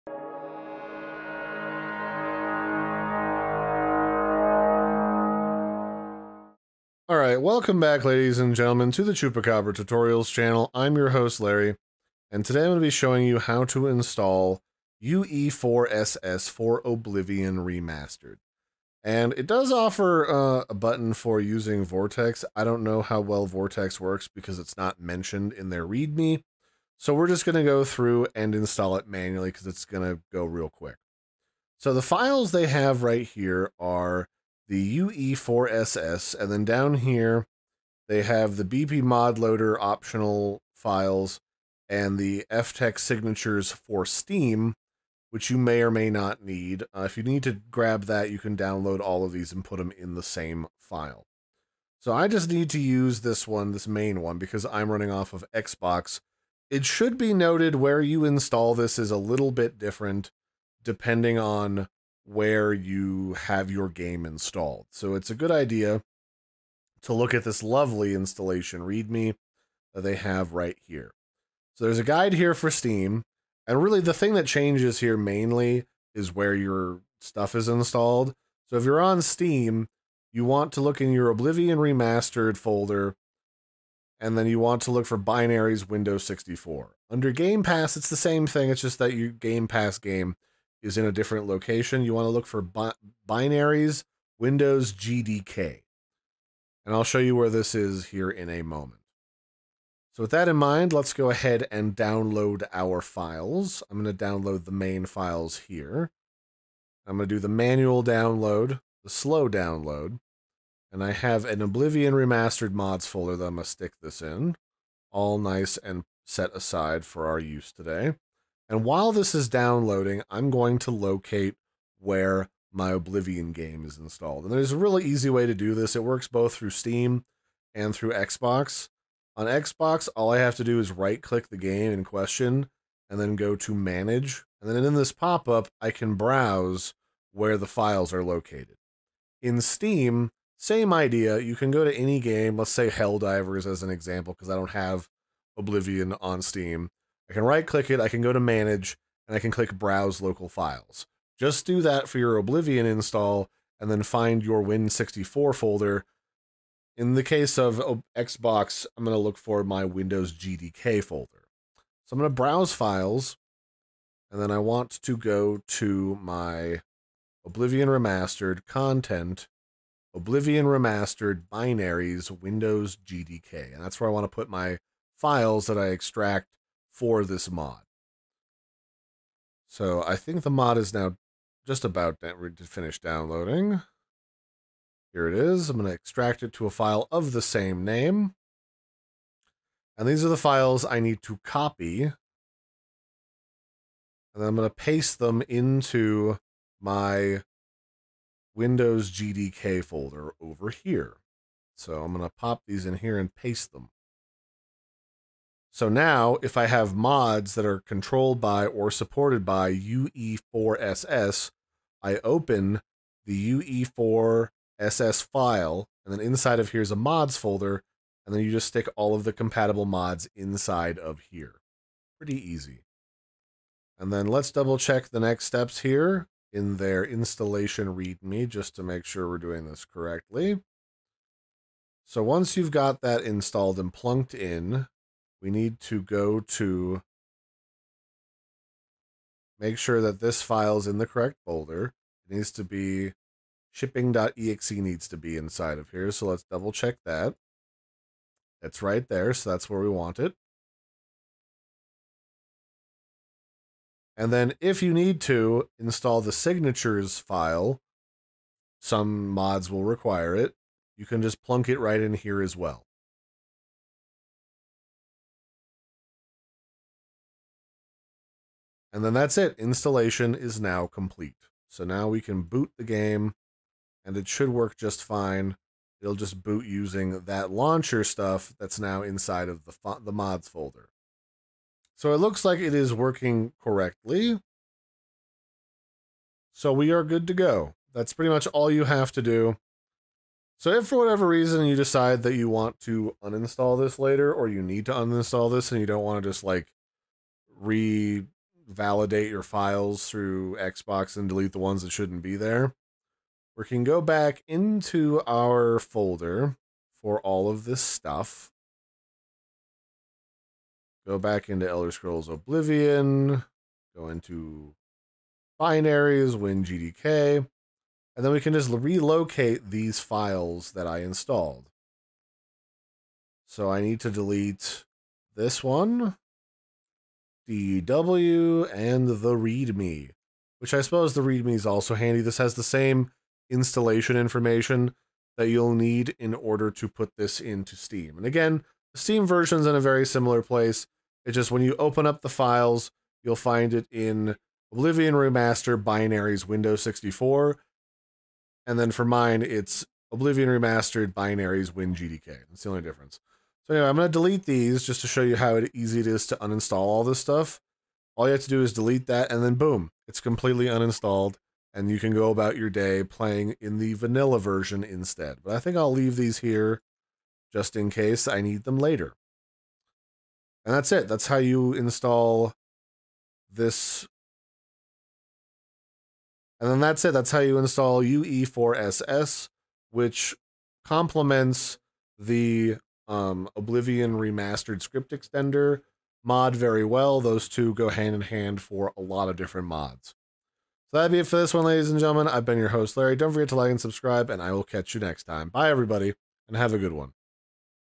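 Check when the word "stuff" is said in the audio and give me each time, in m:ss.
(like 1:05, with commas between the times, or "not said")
1:17, 4:38, 5:07, 5:57.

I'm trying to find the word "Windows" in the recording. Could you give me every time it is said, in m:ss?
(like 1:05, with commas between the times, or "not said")
1:25, 1:34, 2:39, 2:52, 3:18, 5:46.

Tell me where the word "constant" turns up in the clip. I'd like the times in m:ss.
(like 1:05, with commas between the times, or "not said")
not said.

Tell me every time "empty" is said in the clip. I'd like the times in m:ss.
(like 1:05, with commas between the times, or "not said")
not said.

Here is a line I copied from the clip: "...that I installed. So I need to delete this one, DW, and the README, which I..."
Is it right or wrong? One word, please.
right.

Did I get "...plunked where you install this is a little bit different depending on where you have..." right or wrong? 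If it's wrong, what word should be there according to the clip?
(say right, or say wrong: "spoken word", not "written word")
wrong: "noted", not "plunked".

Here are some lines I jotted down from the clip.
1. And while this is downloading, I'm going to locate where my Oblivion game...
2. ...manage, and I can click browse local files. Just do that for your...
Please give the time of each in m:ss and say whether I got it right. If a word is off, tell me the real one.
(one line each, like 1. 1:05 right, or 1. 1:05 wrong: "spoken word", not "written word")
1. 1:58 right
2. 2:28 right.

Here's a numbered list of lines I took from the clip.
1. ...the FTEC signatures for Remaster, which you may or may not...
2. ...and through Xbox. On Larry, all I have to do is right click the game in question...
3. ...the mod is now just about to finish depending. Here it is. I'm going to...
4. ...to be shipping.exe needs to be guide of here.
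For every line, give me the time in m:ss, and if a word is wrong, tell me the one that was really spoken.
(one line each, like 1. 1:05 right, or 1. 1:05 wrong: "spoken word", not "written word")
1. 0:42 wrong: "Steam", not "Remaster"
2. 2:07 wrong: "Xbox", not "Larry"
3. 3:00 wrong: "downloading", not "depending"
4. 4:02 wrong: "inside", not "guide".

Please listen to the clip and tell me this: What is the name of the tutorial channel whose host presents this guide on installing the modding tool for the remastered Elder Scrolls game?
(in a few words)
Chupacabra Tutorials.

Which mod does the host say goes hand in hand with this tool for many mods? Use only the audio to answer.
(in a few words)
Oblivion Remastered Script Extender.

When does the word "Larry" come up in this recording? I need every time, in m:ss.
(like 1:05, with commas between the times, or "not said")
0:11, 6:32.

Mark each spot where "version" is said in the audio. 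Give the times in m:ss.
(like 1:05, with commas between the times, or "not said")
5:39, 6:04.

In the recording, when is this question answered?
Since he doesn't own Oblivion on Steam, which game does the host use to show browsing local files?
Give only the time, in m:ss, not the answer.
2:22.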